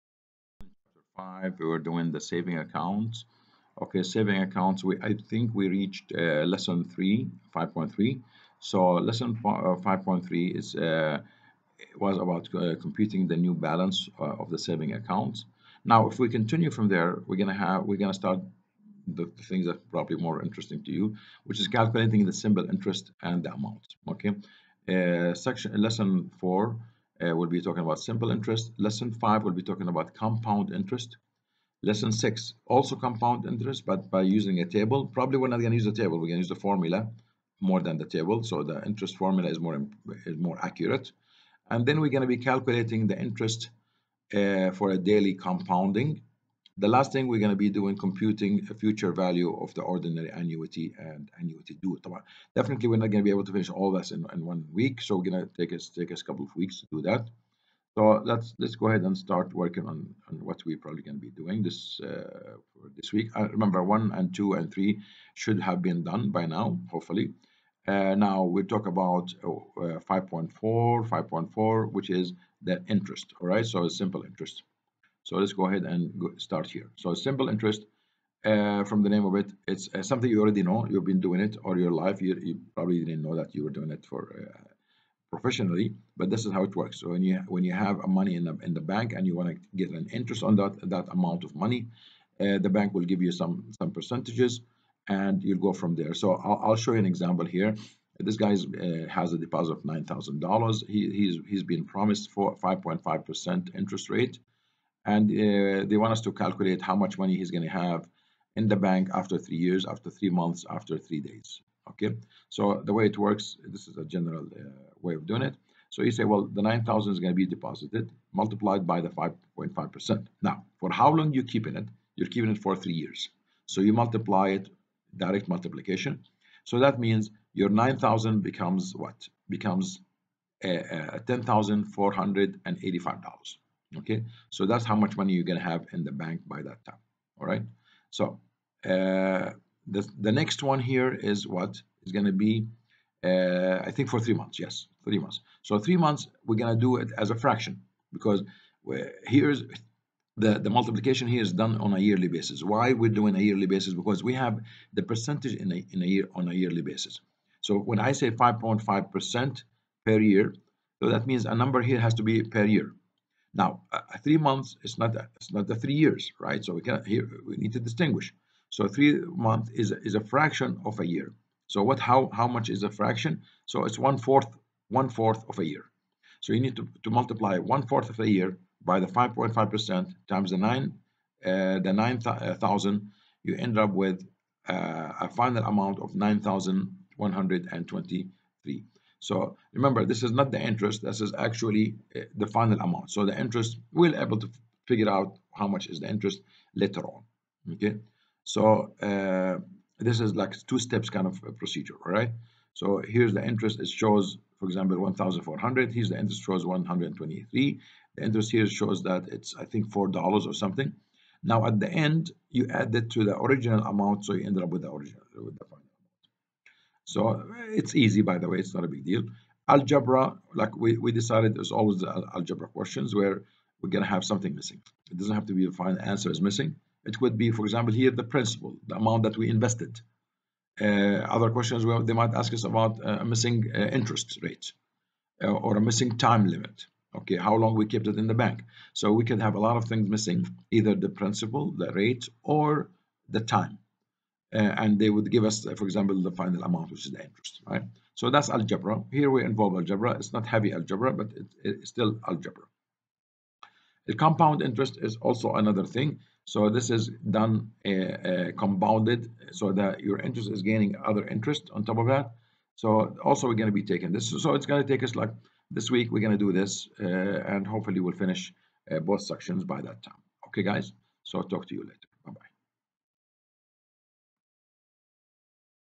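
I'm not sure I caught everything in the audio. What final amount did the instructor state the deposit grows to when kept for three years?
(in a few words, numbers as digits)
$10,485.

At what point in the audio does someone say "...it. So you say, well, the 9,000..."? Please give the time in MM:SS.
01:55.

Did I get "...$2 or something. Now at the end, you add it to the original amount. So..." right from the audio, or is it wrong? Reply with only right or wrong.
wrong.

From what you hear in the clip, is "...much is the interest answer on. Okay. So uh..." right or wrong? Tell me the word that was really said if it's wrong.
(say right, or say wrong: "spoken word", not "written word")
wrong: "later", not "answer".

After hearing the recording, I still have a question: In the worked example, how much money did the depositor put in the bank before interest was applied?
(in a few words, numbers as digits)
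$9,000.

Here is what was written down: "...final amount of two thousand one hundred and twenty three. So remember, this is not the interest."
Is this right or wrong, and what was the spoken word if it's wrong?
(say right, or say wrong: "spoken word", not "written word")
wrong: "nine", not "two".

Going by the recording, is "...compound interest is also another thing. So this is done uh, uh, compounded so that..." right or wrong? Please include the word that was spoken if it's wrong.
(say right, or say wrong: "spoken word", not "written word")
right.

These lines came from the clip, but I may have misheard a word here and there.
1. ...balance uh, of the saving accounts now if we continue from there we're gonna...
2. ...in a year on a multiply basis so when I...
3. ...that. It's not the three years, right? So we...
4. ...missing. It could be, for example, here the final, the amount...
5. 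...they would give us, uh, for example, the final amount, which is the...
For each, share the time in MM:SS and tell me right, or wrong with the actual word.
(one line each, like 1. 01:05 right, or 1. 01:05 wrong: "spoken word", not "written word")
1. 00:13 right
2. 02:35 wrong: "yearly", not "multiply"
3. 02:45 right
4. 03:46 wrong: "principal", not "final"
5. 04:04 right.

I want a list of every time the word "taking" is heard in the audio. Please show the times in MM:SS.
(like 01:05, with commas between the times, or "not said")
04:23.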